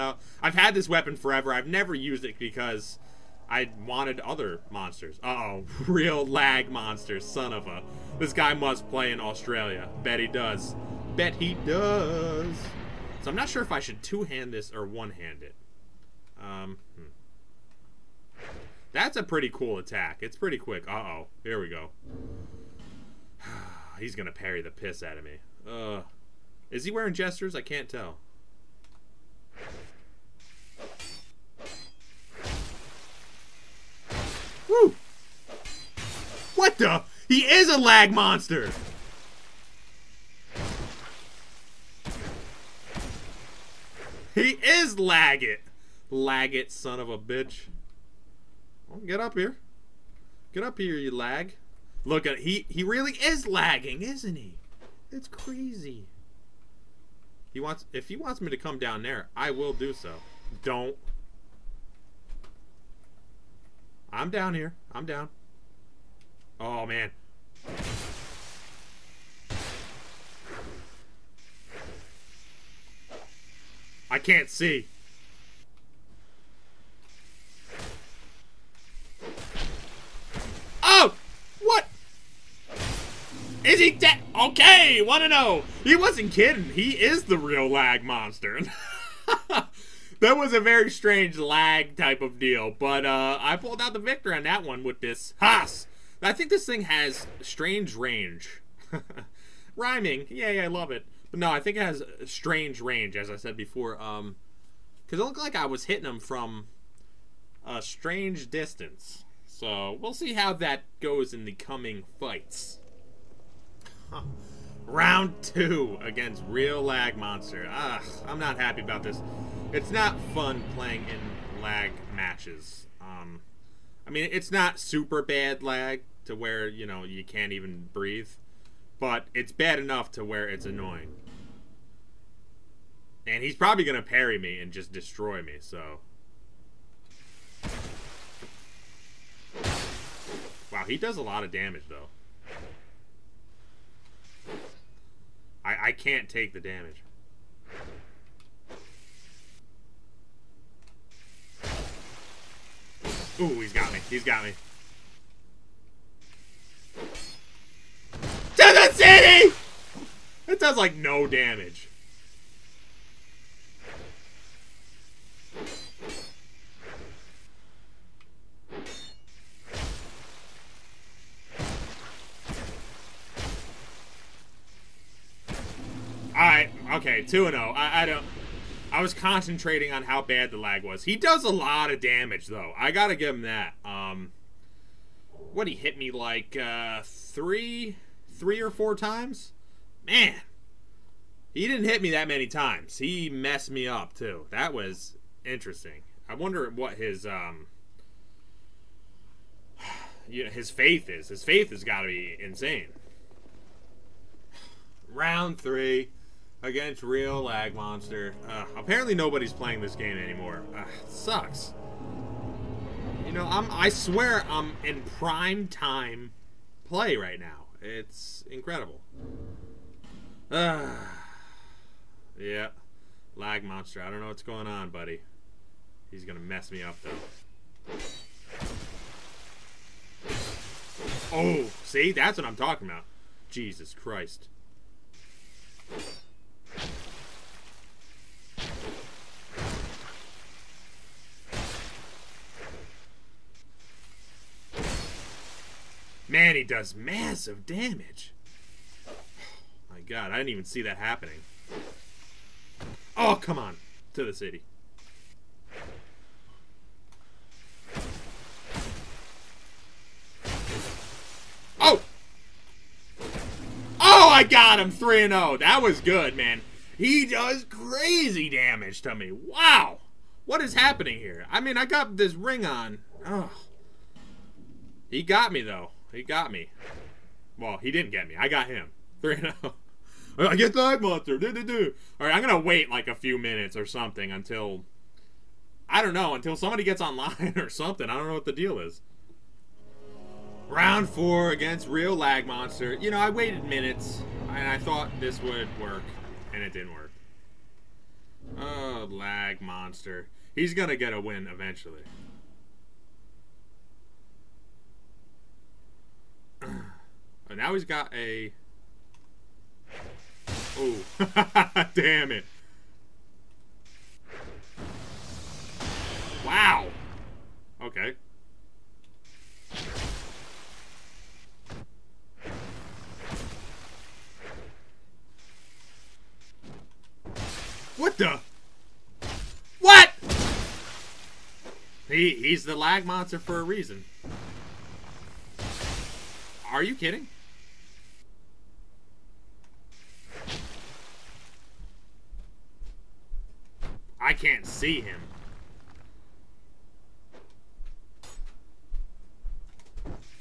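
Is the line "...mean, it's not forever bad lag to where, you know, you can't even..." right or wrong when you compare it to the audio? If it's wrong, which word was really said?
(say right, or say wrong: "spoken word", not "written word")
wrong: "super", not "forever".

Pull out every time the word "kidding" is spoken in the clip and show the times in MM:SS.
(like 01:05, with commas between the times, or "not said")
01:26, 05:36.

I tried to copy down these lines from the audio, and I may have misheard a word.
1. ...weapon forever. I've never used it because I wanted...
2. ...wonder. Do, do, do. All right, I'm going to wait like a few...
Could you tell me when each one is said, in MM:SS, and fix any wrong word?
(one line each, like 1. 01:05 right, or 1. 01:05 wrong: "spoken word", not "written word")
1. 00:00 right
2. 04:41 wrong: "monster", not "wonder".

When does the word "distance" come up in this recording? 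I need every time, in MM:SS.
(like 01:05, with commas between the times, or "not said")
01:48.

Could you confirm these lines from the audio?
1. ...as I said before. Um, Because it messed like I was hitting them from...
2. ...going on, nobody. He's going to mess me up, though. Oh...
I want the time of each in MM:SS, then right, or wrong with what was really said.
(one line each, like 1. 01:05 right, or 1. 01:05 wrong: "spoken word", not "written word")
1. 01:43 wrong: "looked", not "messed"
2. 03:44 wrong: "buddy", not "nobody".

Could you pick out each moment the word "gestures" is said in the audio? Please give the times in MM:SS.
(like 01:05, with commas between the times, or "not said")
00:27.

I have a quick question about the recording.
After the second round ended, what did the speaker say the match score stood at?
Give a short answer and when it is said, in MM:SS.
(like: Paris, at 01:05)
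2-0, at 02:57.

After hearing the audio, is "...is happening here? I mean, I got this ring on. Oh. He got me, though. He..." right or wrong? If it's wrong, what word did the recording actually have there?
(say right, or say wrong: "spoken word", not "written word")
right.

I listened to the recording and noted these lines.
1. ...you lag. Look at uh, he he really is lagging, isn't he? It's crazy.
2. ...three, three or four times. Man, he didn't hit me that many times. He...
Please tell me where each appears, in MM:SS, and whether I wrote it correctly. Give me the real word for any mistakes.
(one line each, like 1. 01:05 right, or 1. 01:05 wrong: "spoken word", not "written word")
1. 00:50 right
2. 03:07 right.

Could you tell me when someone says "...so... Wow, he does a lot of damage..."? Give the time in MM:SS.
02:15.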